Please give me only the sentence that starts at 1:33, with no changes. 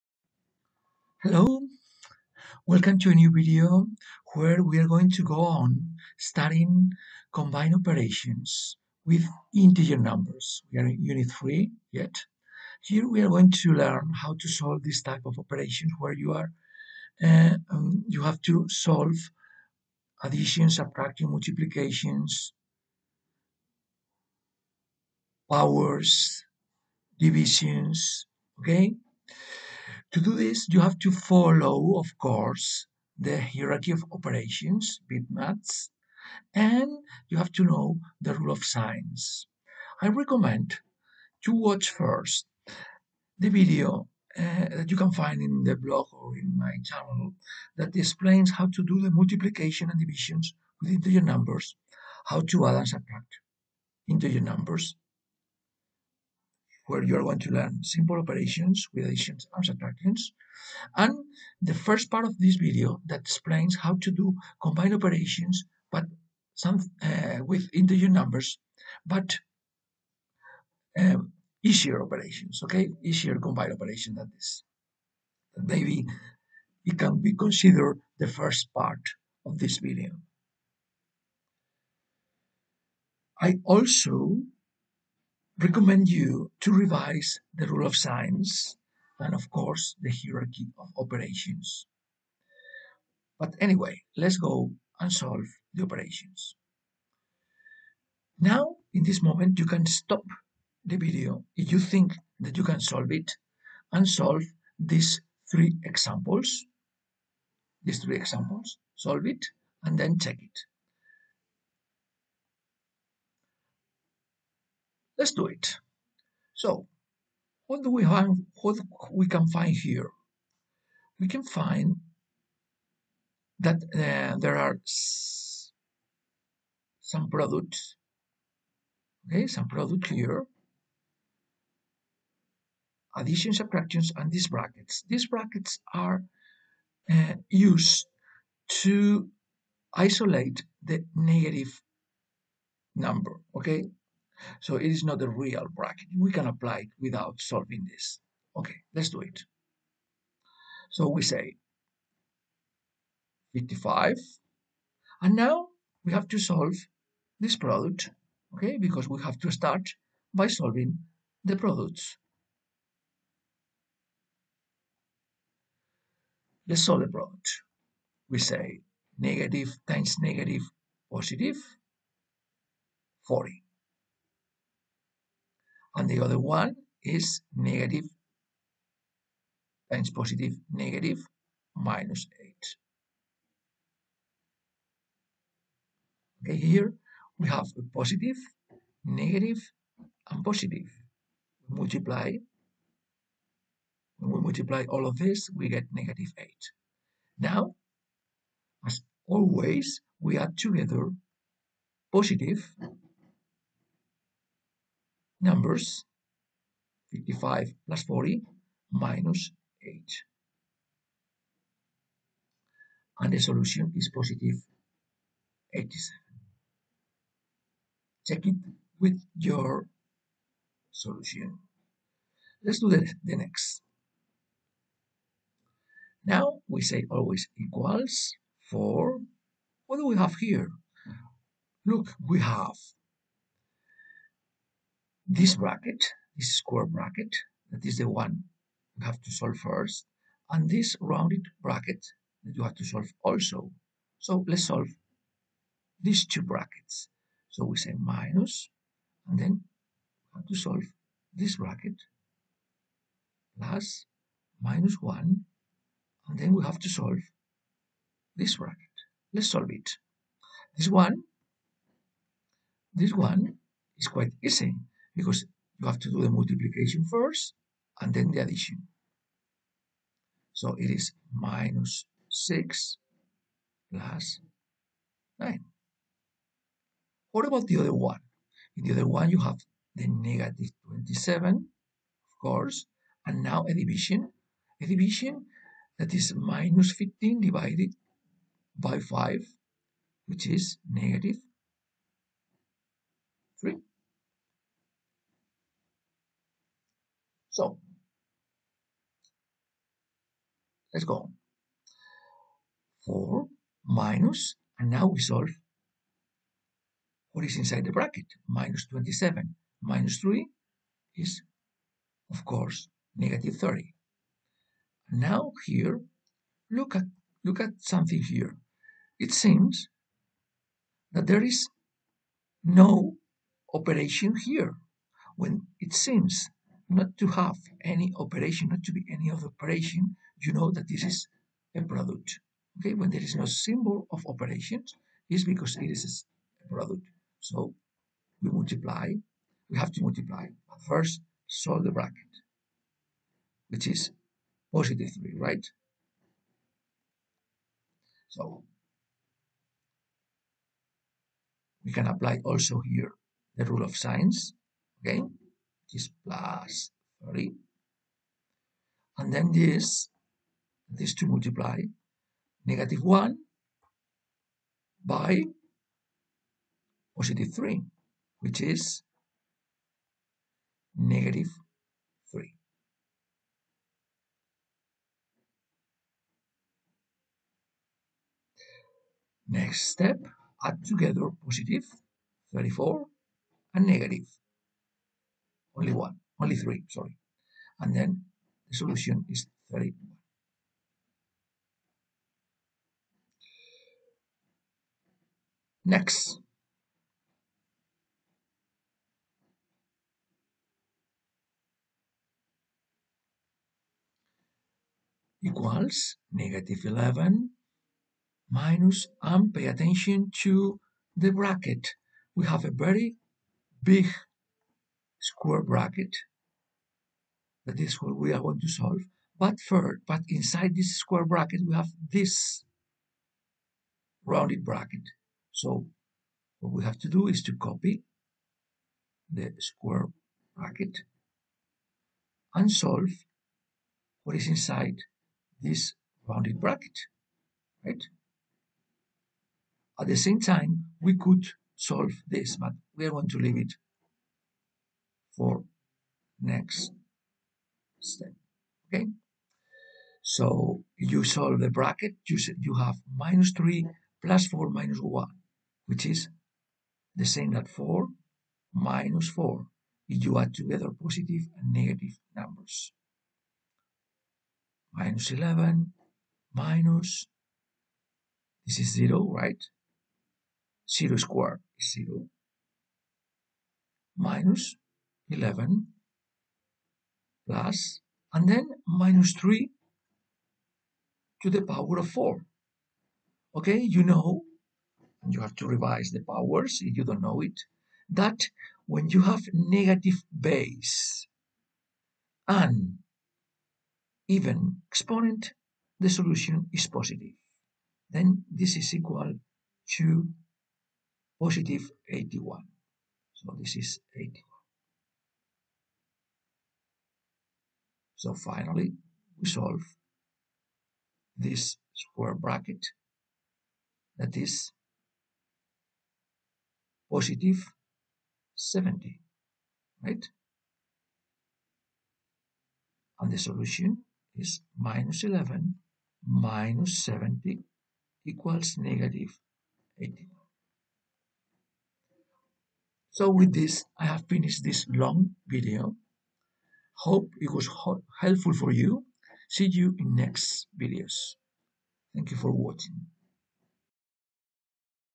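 But anyway, let's go and solve the operations.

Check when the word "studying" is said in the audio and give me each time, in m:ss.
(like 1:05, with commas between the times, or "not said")
0:06.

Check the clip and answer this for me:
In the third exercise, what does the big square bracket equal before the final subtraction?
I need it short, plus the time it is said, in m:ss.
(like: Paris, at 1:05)
70, at 8:37.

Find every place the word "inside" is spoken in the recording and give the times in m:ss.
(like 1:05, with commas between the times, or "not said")
5:07, 7:00, 7:14.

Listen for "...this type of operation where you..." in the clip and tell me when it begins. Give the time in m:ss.
0:14.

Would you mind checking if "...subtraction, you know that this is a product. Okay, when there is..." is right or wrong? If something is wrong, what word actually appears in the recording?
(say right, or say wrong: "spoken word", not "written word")
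wrong: "operation", not "subtraction".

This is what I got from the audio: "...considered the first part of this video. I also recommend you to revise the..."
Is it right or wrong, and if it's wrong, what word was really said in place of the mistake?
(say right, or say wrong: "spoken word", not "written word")
right.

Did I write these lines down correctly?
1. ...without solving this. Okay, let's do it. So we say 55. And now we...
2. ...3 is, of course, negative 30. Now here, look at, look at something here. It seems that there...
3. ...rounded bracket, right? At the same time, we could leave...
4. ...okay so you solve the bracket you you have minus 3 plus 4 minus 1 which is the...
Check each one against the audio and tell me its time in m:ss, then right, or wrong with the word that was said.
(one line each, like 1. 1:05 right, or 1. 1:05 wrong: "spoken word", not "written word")
1. 2:26 right
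2. 5:10 right
3. 7:16 wrong: "solve", not "leave"
4. 7:28 right.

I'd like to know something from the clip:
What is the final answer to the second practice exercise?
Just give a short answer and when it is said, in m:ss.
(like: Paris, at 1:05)
31, at 6:29.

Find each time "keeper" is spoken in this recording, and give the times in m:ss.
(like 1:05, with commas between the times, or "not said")
not said.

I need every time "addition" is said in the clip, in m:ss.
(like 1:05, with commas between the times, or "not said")
0:20, 0:59, 2:13, 4:28.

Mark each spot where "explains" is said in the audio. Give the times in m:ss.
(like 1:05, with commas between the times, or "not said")
0:47, 1:03.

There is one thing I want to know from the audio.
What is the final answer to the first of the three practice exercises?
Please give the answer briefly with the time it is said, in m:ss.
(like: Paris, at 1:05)
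87, at 3:34.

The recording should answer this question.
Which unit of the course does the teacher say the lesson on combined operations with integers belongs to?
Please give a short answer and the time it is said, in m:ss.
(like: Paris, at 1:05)
Unit 3, at 0:11.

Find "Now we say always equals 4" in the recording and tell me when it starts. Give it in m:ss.
3:46.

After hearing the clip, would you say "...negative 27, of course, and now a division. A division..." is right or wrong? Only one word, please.
right.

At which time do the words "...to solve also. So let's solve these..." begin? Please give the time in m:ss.
4:02.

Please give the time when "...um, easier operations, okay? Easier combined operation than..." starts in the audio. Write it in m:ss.
1:11.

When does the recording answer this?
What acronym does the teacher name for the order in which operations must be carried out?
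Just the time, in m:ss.
0:35.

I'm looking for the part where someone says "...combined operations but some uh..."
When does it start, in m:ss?
1:04.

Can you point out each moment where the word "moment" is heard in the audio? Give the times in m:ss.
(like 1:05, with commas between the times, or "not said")
1:39.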